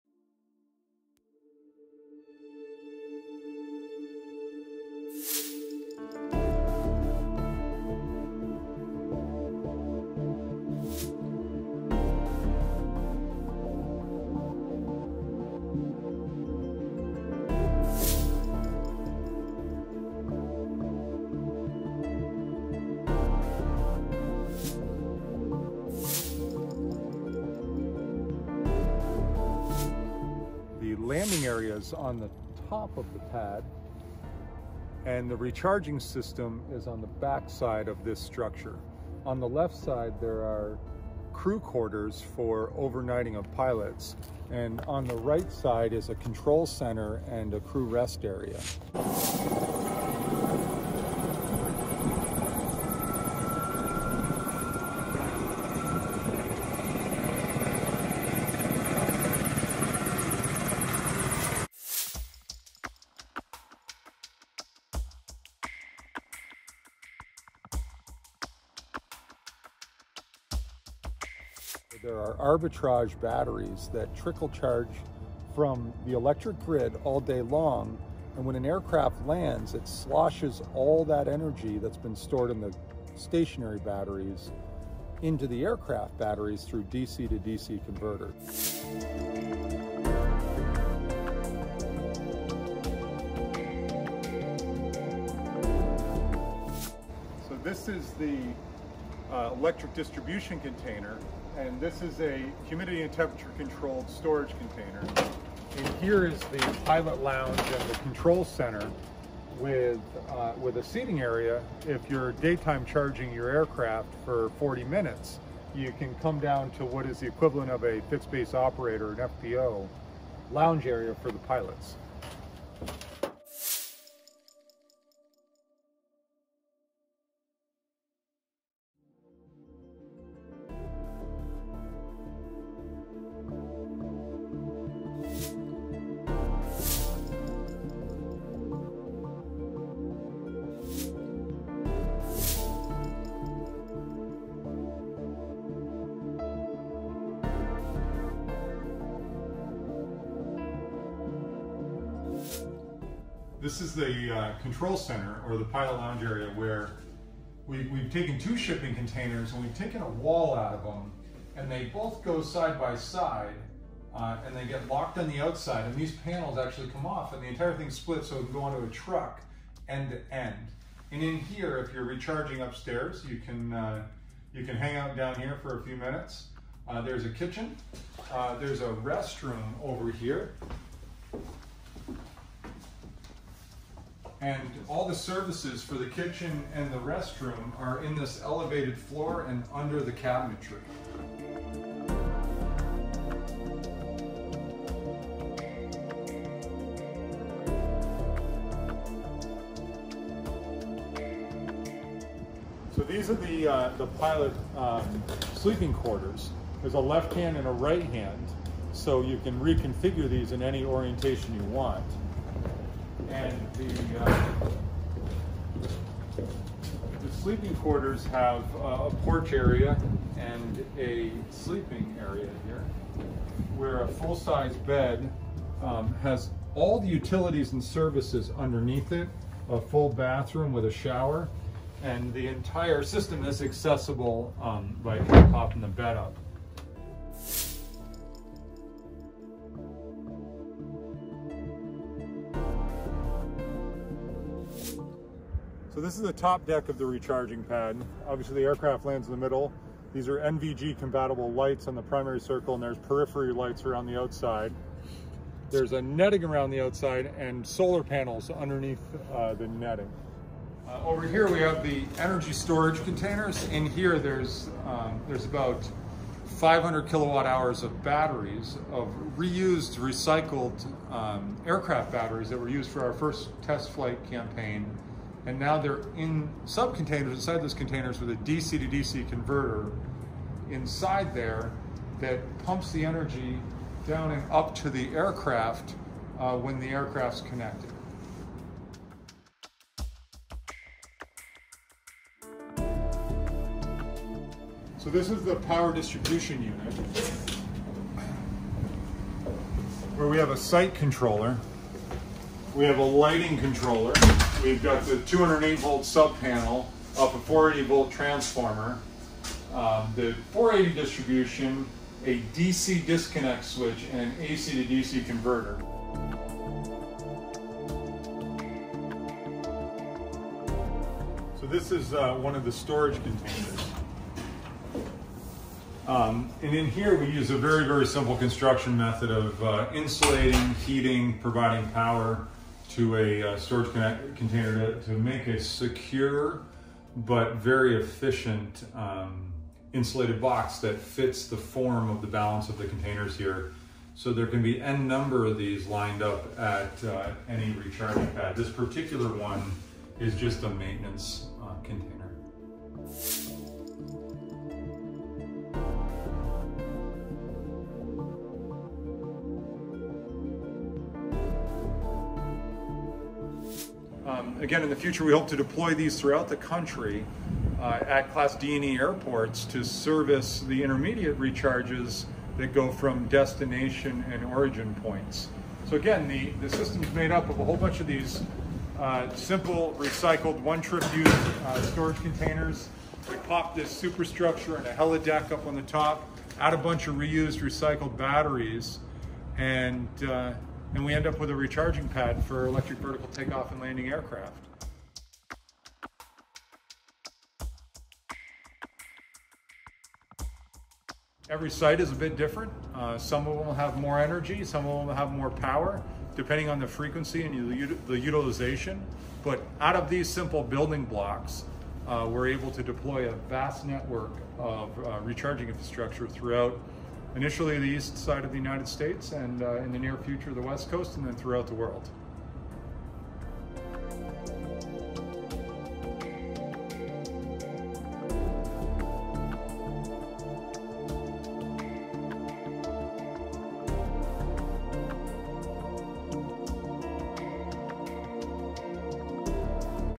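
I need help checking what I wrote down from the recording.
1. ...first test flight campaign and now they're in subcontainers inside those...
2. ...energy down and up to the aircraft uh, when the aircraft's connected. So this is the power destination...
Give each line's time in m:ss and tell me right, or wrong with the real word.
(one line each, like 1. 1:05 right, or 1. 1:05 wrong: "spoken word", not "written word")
1. 4:33 right
2. 4:43 wrong: "distribution", not "destination".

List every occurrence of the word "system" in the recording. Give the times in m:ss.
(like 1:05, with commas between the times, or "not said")
0:35, 3:53, 6:16.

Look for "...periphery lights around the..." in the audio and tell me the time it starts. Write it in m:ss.
4:12.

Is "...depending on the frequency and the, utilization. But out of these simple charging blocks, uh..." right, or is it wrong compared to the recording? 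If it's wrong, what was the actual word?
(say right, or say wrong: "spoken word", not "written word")
wrong: "building", not "charging".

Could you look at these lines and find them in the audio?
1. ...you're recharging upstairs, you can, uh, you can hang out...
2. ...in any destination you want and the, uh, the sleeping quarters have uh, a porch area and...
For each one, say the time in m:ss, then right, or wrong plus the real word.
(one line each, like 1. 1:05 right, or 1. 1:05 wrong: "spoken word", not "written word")
1. 2:51 right
2. 3:30 wrong: "orientation", not "destination".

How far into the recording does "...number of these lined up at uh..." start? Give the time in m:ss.
5:45.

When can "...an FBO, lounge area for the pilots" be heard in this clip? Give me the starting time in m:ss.
1:59.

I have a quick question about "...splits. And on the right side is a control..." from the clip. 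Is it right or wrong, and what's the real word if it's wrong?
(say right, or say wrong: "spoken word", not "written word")
wrong: "pilots", not "splits".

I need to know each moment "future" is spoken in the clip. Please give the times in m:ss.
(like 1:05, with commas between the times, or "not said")
6:04, 7:00.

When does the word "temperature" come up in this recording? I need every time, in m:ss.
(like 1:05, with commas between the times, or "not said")
1:43.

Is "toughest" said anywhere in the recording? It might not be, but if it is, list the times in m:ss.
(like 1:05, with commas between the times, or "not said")
not said.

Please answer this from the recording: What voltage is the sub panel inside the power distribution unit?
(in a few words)
208 volts.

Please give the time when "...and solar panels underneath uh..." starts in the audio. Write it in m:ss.
4:17.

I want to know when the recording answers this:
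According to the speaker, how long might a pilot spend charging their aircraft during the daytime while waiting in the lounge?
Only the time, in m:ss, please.
1:54.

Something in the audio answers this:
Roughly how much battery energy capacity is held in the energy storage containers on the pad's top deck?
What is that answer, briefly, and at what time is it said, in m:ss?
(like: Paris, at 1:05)
500 kilowatt hours, at 4:26.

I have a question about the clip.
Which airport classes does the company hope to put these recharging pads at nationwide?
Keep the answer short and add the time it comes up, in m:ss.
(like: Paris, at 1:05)
Class D and E, at 6:08.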